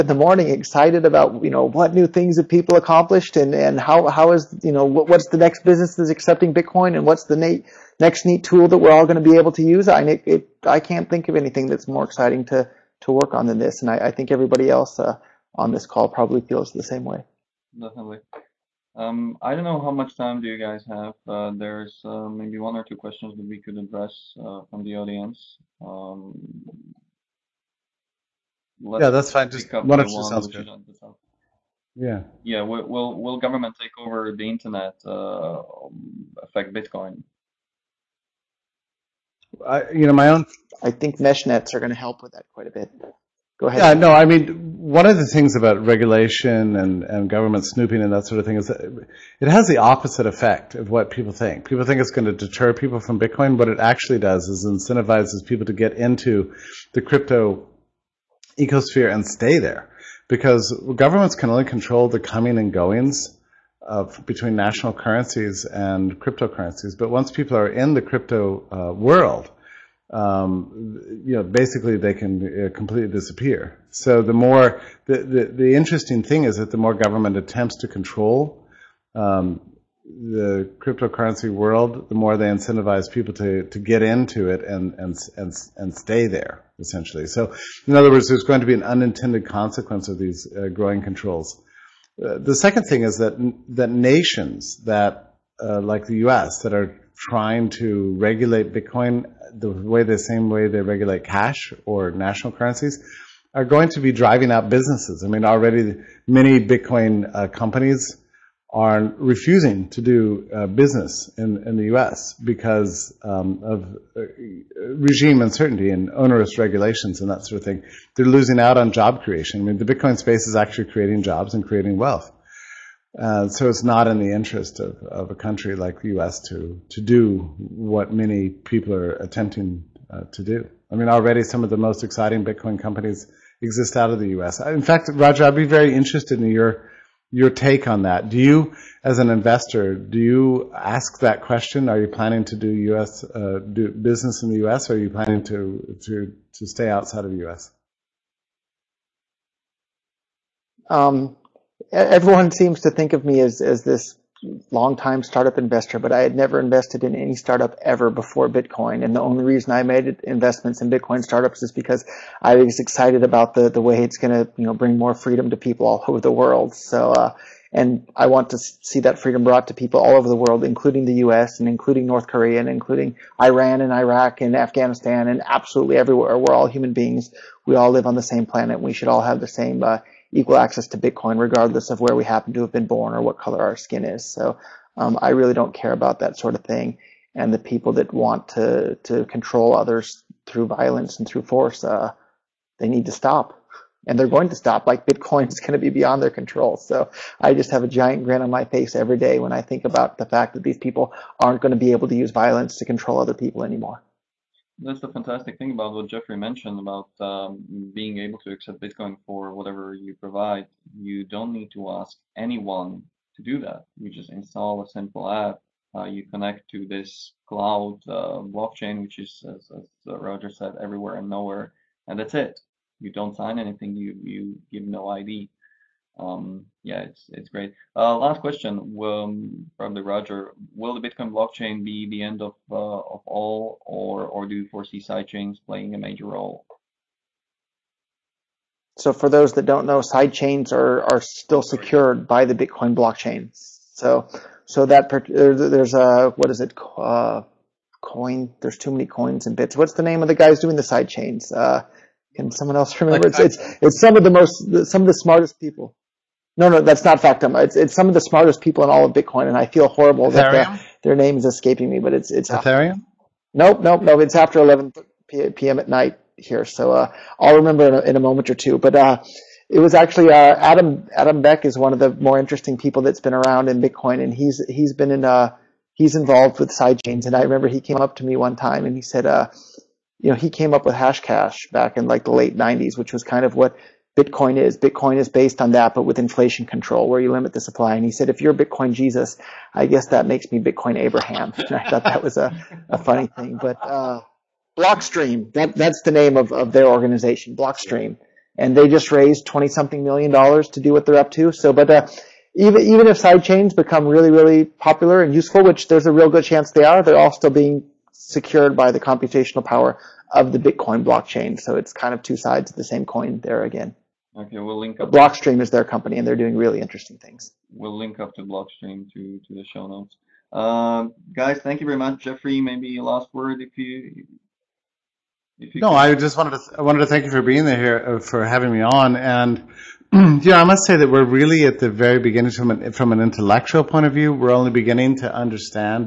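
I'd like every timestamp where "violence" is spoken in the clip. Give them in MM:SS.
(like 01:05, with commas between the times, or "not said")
03:10, 03:22.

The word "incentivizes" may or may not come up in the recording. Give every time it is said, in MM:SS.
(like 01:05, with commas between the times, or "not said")
00:54, 01:22.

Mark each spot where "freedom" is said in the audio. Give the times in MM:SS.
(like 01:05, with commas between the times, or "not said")
02:45, 02:49.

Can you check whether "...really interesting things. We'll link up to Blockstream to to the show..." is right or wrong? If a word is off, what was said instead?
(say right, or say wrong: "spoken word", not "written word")
right.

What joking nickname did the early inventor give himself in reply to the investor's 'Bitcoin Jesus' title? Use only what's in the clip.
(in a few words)
Bitcoin Abraham.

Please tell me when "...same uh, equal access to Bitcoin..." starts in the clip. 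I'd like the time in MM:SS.
02:59.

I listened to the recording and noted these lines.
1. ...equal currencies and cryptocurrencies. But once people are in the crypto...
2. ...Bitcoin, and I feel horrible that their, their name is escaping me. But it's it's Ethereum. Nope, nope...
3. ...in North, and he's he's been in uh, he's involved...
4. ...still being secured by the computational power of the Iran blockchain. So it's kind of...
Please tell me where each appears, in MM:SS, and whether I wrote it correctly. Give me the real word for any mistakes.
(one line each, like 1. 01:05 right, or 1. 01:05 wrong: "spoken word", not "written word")
1. 01:04 wrong: "national", not "equal"
2. 04:19 right
3. 04:33 wrong: "Bitcoin", not "North"
4. 05:07 wrong: "Bitcoin", not "Iran".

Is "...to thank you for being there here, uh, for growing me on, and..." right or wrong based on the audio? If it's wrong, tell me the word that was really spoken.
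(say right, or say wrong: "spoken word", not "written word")
wrong: "having", not "growing".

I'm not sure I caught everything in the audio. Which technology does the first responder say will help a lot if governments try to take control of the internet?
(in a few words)
Mesh nets.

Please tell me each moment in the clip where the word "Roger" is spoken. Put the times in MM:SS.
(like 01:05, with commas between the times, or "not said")
02:15, 03:40, 03:50.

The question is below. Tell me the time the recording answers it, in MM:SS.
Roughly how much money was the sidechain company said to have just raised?
04:59.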